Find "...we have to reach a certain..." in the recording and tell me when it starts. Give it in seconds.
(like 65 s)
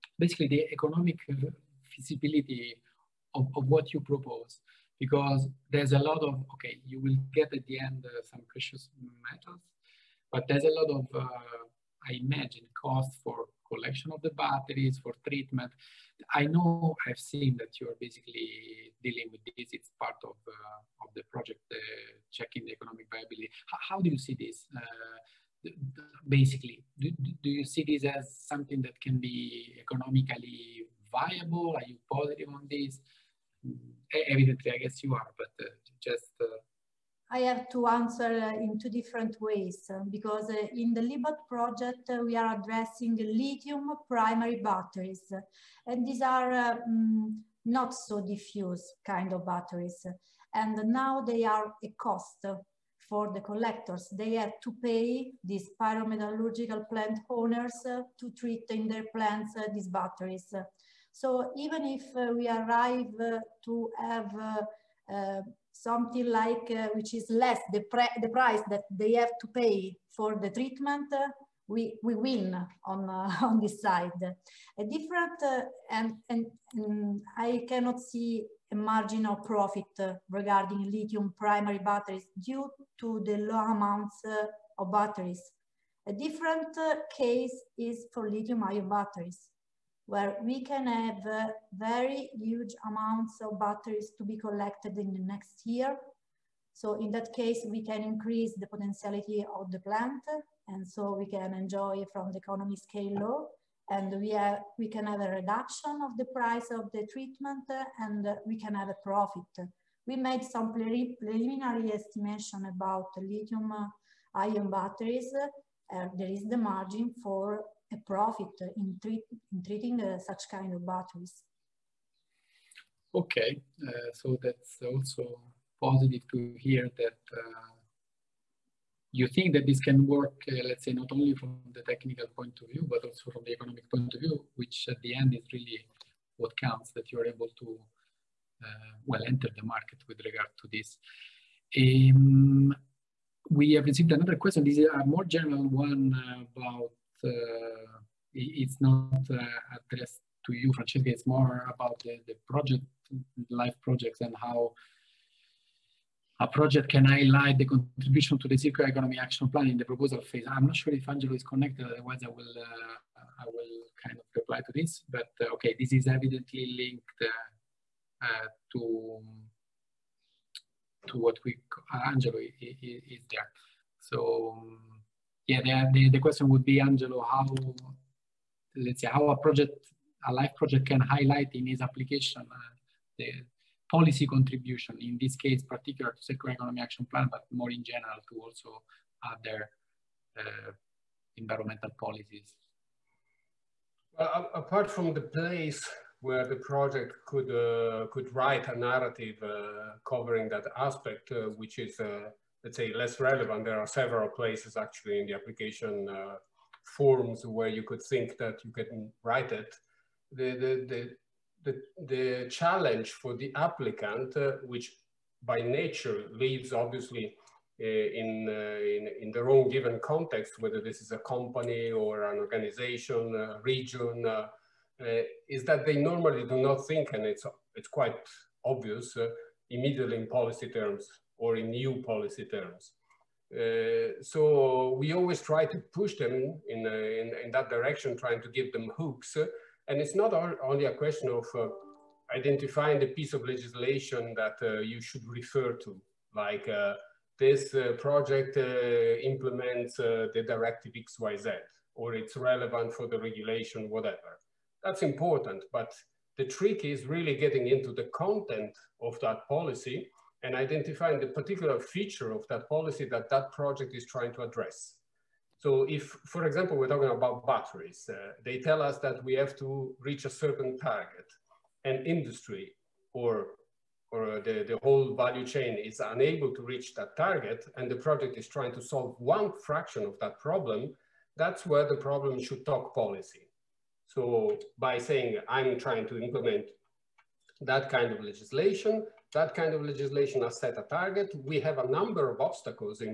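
269 s.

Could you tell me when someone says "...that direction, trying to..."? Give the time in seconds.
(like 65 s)
237 s.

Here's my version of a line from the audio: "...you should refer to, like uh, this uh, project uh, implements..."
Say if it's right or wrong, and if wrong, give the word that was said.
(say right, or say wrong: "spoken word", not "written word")
right.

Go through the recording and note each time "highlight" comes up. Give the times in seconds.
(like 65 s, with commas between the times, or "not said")
157 s, 180 s.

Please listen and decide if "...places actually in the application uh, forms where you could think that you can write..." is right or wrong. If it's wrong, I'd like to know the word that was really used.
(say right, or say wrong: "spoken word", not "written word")
right.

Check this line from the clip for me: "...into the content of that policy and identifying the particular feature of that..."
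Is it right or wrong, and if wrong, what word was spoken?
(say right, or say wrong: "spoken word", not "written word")
right.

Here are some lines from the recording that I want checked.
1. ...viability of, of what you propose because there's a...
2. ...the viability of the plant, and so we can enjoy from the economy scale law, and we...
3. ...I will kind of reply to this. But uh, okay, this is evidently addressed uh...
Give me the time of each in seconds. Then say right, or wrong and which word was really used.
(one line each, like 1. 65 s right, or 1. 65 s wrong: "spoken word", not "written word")
1. 1 s wrong: "feasibility", not "viability"
2. 98 s wrong: "potentiality", not "viability"
3. 163 s wrong: "linked", not "addressed".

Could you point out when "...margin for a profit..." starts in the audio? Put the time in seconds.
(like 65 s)
116 s.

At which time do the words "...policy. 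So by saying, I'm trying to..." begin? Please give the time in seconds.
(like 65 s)
282 s.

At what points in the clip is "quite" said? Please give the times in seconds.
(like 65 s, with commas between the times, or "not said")
227 s.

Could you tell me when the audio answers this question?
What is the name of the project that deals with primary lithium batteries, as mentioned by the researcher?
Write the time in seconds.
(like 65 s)
41 s.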